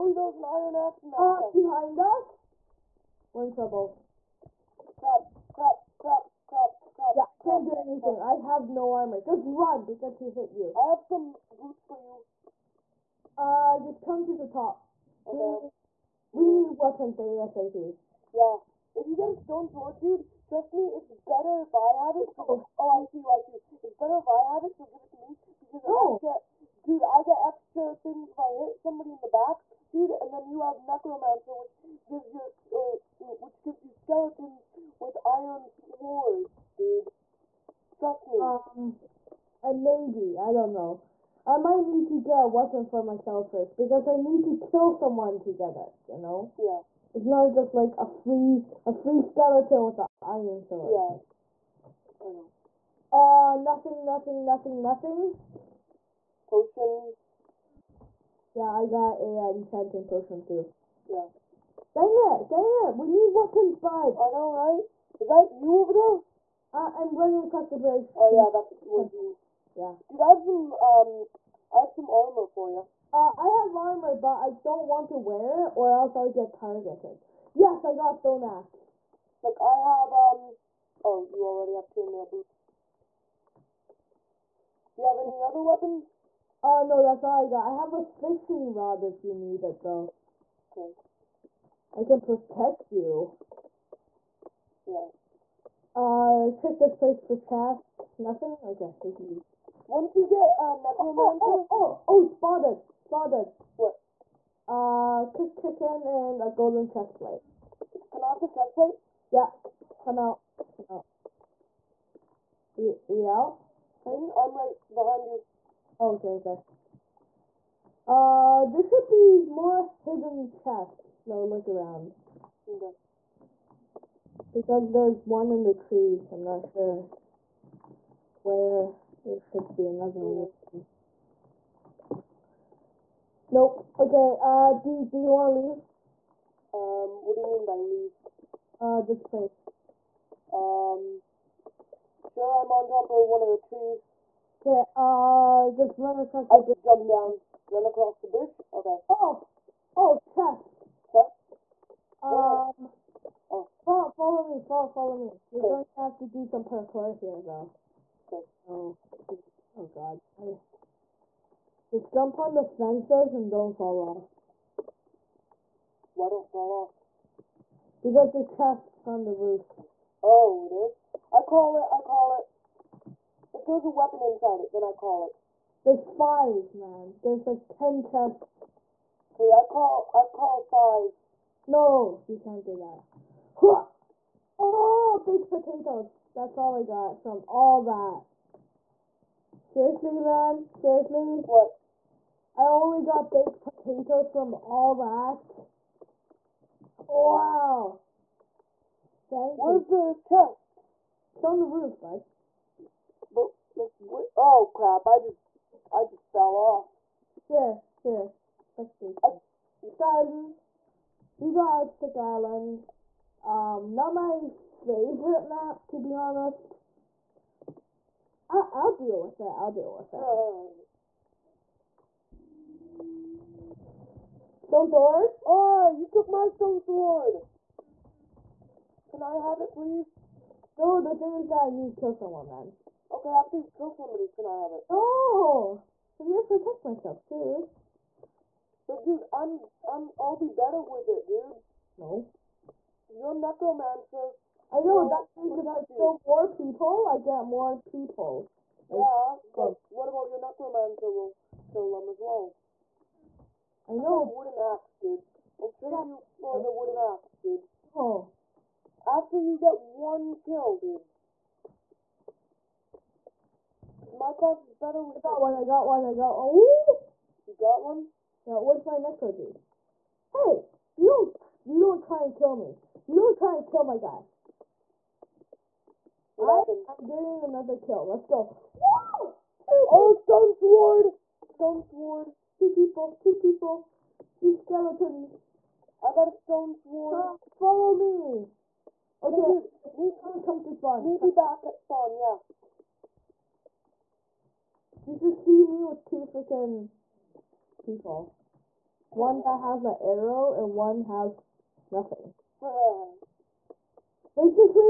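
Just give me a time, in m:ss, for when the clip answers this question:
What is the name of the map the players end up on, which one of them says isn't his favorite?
3:31.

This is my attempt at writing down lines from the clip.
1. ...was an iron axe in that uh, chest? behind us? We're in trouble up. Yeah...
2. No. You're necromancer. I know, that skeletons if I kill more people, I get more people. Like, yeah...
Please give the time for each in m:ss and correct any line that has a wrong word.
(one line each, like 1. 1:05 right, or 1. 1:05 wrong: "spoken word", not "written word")
1. 0:00 right
2. 4:01 wrong: "means", not "skeletons".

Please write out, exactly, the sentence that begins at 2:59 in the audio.
Okay, I call I call five.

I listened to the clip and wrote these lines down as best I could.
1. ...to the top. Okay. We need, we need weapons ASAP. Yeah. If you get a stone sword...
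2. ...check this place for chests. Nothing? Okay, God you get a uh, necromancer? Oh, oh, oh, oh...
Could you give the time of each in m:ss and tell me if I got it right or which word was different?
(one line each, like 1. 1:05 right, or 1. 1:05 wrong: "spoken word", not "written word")
1. 0:14 right
2. 1:36 wrong: "Once", not "God".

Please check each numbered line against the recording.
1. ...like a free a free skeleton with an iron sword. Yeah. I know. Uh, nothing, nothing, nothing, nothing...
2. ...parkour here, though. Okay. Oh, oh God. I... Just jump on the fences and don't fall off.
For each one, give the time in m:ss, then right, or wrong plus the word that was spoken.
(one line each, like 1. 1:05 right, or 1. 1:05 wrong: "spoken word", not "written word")
1. 0:47 right
2. 2:36 right.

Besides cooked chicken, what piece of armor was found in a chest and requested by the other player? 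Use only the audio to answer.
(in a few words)
Golden chest plate.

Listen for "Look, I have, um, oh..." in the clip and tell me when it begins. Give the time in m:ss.
1:19.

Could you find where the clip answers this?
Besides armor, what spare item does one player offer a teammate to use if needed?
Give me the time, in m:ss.
1:27.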